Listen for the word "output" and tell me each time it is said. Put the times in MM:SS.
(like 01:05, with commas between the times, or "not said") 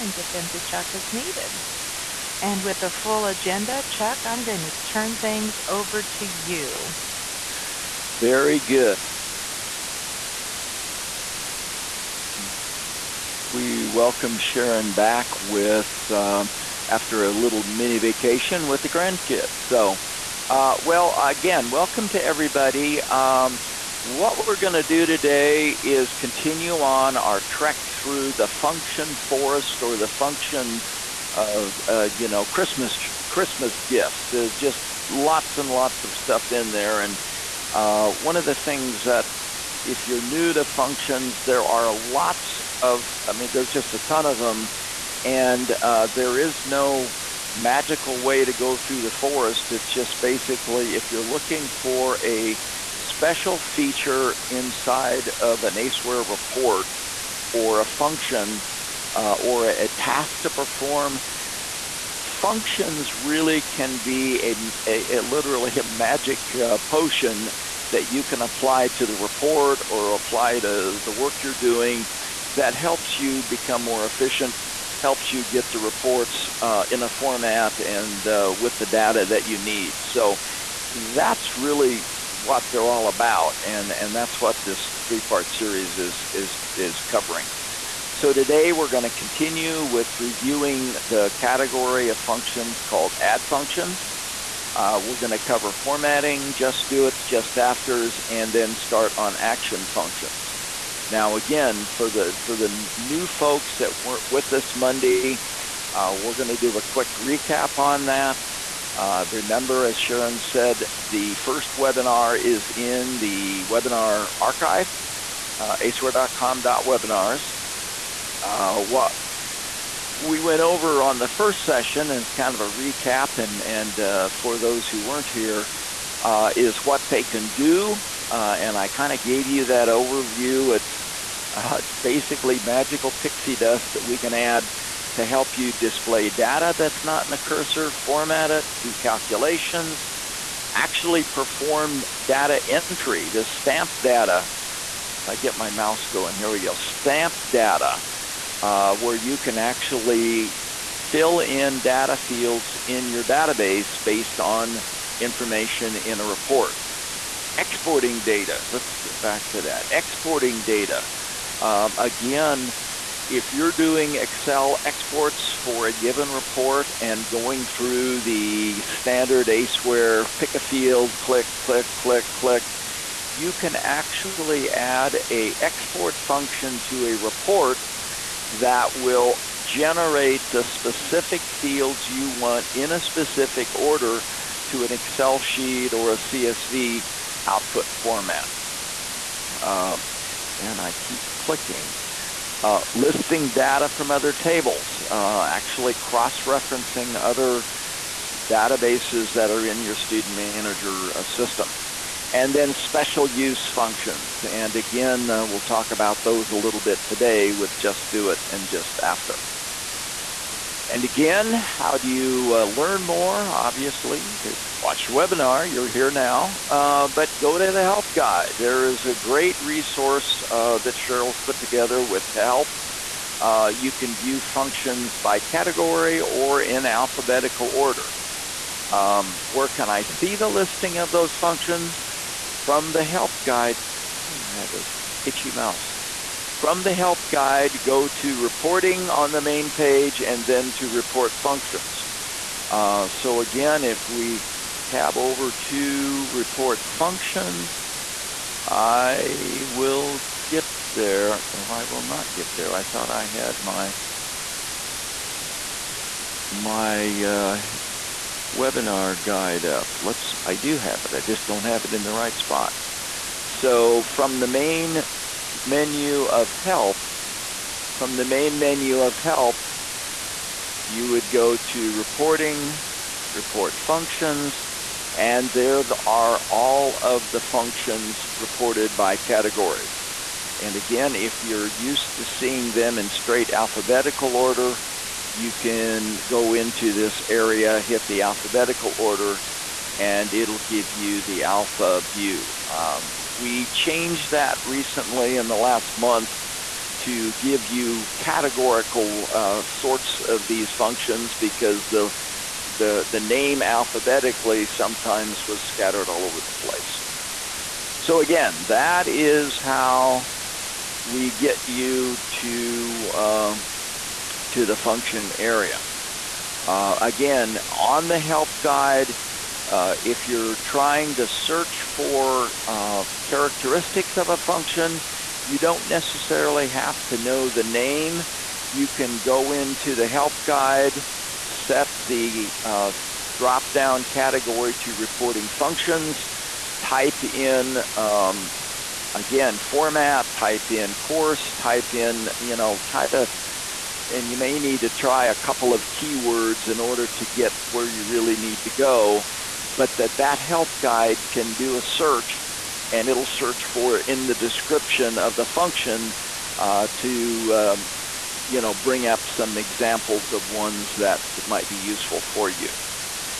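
03:07.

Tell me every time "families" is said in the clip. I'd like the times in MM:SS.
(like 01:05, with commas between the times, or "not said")
not said.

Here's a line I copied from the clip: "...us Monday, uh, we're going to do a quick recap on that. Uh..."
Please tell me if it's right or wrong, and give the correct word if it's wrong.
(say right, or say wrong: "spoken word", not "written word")
right.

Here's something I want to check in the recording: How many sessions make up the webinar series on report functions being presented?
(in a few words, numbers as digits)
3.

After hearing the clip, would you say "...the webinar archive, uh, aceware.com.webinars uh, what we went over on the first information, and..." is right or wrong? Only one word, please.
wrong.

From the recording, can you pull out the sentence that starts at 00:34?
There's just lots and lots of stuff in there.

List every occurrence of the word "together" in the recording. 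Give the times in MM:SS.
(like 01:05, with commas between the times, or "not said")
03:41.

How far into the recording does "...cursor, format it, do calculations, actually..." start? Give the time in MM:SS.
02:17.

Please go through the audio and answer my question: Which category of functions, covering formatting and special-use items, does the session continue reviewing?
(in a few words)
add functions.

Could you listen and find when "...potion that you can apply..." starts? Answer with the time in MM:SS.
01:06.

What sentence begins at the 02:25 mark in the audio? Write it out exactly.
If I get my mouse going, here we go, stamp data.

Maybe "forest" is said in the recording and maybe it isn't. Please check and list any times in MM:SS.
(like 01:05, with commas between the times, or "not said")
00:29, 00:49.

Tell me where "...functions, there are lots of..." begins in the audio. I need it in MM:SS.
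00:40.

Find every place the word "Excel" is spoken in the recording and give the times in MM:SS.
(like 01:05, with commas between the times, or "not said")
02:44, 03:04.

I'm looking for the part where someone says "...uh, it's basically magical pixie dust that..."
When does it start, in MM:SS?
02:11.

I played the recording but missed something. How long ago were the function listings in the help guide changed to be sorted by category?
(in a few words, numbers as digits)
the last month.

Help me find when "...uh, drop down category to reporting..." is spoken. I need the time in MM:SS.
05:32.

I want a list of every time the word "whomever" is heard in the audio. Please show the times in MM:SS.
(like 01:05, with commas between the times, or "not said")
not said.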